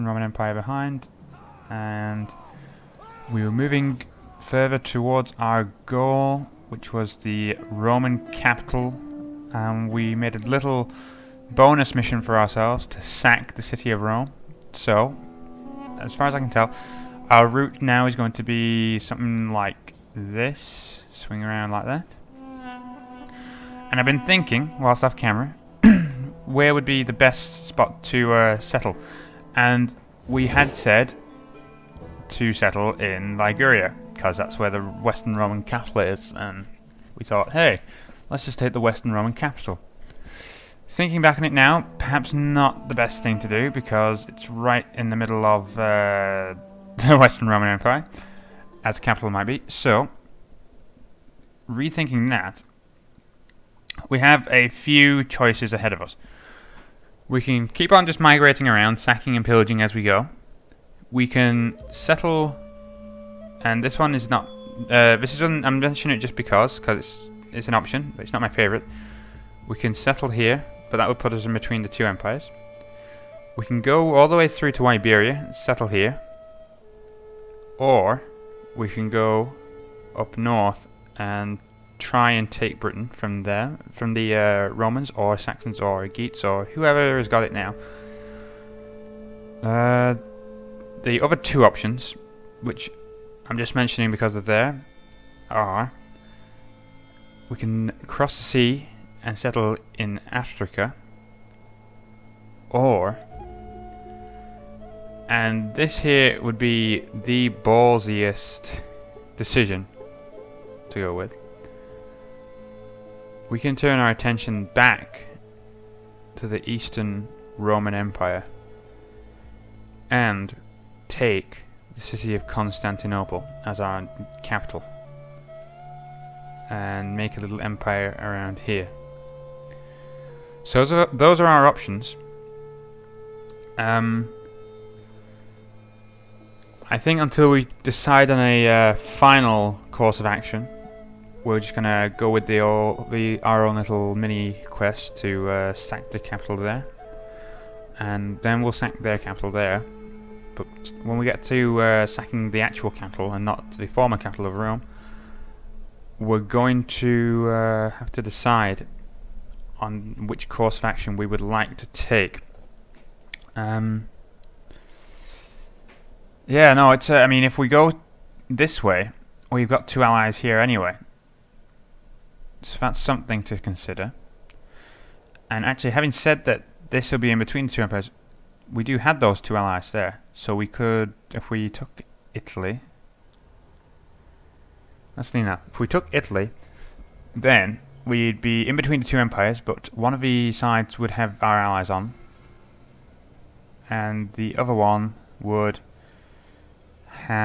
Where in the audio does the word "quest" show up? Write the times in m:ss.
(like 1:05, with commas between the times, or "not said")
2:24.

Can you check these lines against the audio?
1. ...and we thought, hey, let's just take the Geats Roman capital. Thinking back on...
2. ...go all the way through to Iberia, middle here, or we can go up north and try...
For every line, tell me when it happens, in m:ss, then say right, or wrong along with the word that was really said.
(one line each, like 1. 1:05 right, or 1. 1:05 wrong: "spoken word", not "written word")
1. 0:36 wrong: "Western", not "Geats"
2. 1:13 wrong: "settle", not "middle".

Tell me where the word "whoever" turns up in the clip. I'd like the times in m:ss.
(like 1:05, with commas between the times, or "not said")
1:26.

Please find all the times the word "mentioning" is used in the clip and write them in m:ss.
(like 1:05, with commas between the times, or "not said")
1:05, 1:33.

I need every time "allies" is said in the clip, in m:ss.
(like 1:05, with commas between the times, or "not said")
2:50, 2:59, 3:11.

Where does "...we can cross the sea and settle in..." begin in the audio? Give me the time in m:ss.
1:37.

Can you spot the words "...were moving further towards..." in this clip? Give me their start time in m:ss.
0:03.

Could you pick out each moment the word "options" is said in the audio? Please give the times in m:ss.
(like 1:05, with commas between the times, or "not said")
1:07, 1:31, 2:11.